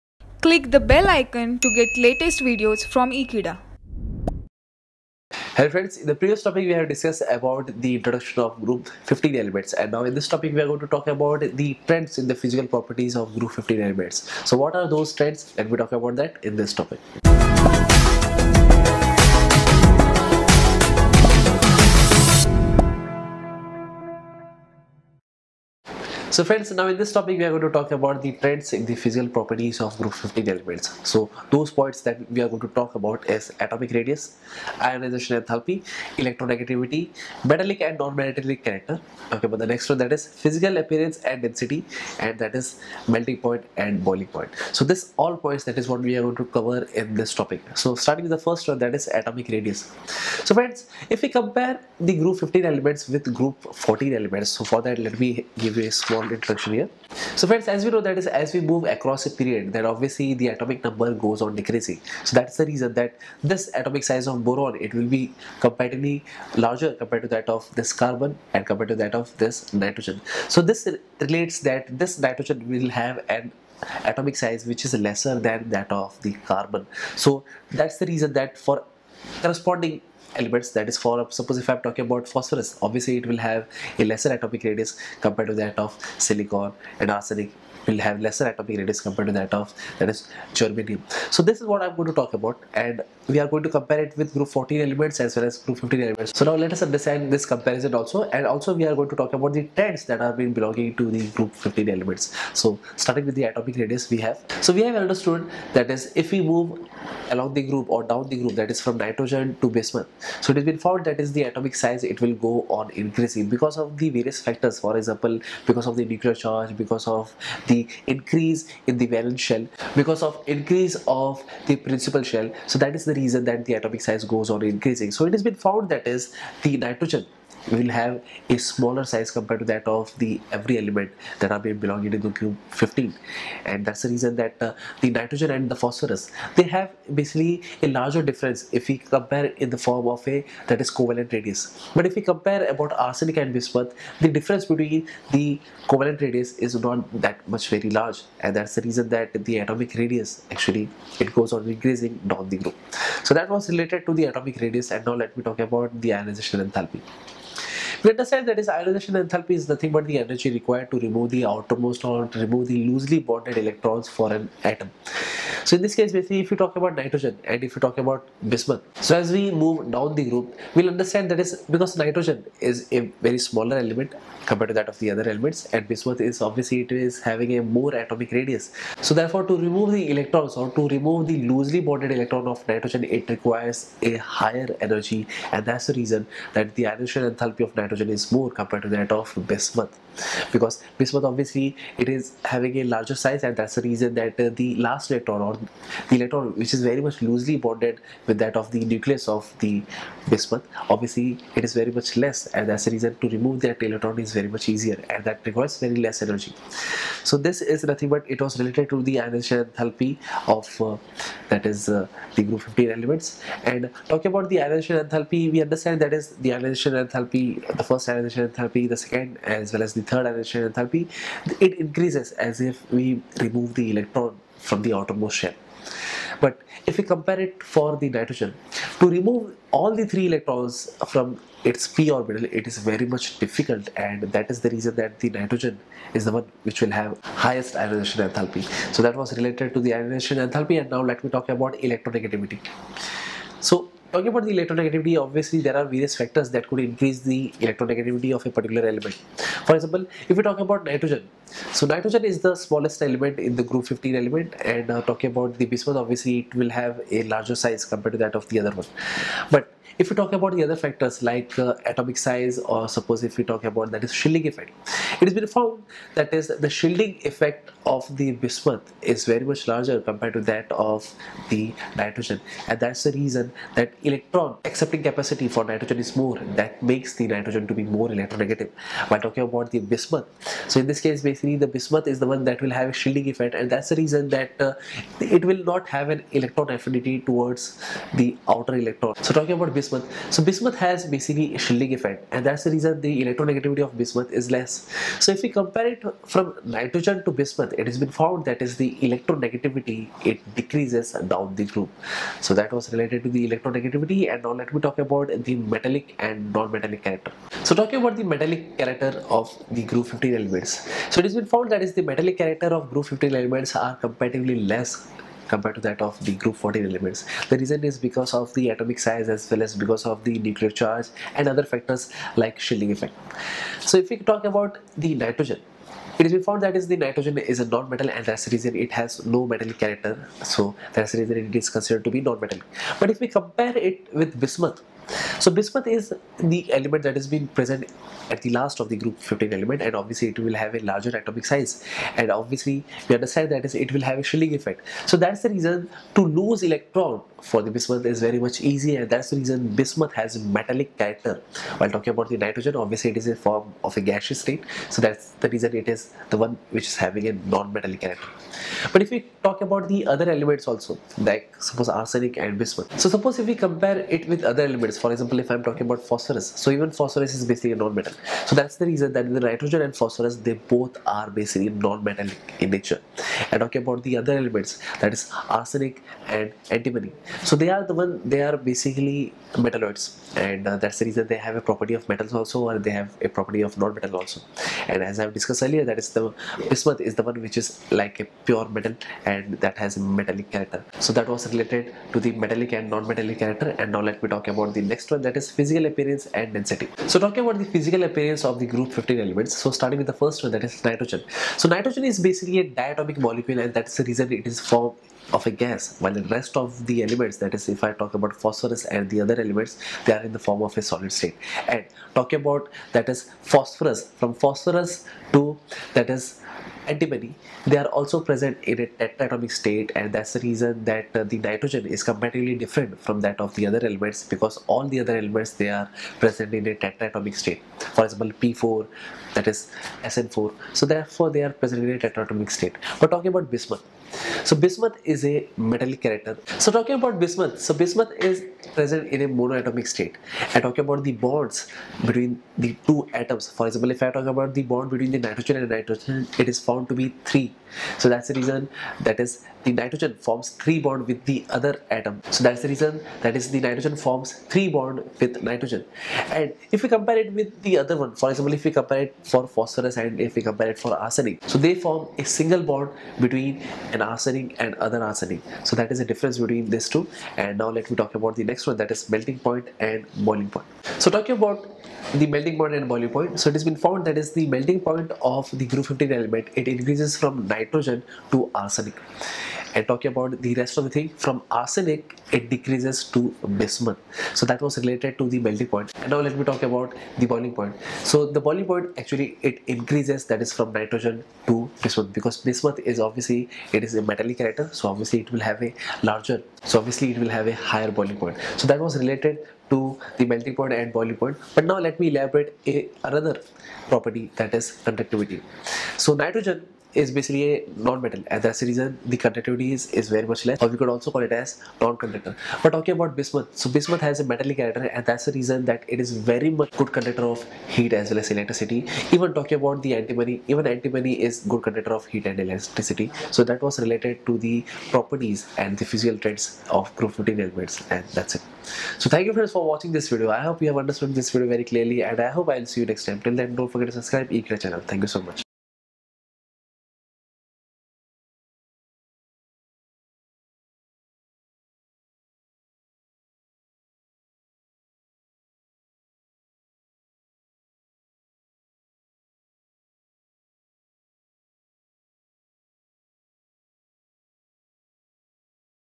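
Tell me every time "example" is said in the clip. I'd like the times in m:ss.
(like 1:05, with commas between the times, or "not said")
1:54, 4:09, 6:05, 7:08, 7:23, 7:38.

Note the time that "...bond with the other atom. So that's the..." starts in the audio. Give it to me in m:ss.
7:30.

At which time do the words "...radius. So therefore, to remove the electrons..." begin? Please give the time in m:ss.
2:58.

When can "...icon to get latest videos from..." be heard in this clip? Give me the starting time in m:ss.
0:01.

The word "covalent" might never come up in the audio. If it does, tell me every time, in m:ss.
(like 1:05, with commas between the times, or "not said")
2:20, 2:25.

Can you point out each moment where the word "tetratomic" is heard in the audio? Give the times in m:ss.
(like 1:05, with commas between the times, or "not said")
6:58, 7:06, 7:11.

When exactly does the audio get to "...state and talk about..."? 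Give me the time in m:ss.
6:51.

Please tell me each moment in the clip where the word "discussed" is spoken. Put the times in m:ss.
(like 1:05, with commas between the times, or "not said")
0:06, 6:25.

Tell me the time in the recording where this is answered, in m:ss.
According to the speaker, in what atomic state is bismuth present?
7:19.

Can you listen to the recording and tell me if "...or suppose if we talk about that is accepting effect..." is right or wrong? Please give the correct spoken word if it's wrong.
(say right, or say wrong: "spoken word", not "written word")
wrong: "shielding", not "accepting".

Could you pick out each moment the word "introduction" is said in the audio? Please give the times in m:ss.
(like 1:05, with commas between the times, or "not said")
0:07, 0:56.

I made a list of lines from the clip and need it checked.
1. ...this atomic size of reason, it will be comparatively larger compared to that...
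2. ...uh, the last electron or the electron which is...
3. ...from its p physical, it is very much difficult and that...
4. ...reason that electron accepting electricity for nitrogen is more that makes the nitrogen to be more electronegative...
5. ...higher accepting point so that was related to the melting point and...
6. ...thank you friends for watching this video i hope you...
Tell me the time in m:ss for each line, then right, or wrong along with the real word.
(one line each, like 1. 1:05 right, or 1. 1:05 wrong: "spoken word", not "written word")
1. 1:03 wrong: "boron", not "reason"
2. 3:14 right
3. 3:51 wrong: "orbital", not "physical"
4. 4:33 wrong: "capacity", not "electricity"
5. 8:17 wrong: "boiling", not "accepting"
6. 8:49 right.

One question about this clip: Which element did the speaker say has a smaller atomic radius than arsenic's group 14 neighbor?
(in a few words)
germanium.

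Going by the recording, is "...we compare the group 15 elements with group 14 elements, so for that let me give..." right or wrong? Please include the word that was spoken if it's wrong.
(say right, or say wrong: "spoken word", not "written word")
right.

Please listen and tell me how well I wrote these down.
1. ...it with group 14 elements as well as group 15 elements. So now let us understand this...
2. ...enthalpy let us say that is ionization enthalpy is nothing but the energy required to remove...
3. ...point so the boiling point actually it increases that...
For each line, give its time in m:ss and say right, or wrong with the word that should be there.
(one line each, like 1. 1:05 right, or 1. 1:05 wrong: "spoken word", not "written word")
1. 1:34 right
2. 2:36 right
3. 8:07 right.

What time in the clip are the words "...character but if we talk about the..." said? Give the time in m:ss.
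5:57.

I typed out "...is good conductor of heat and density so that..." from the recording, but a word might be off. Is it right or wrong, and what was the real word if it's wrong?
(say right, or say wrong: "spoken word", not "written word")
wrong: "electricity", not "density".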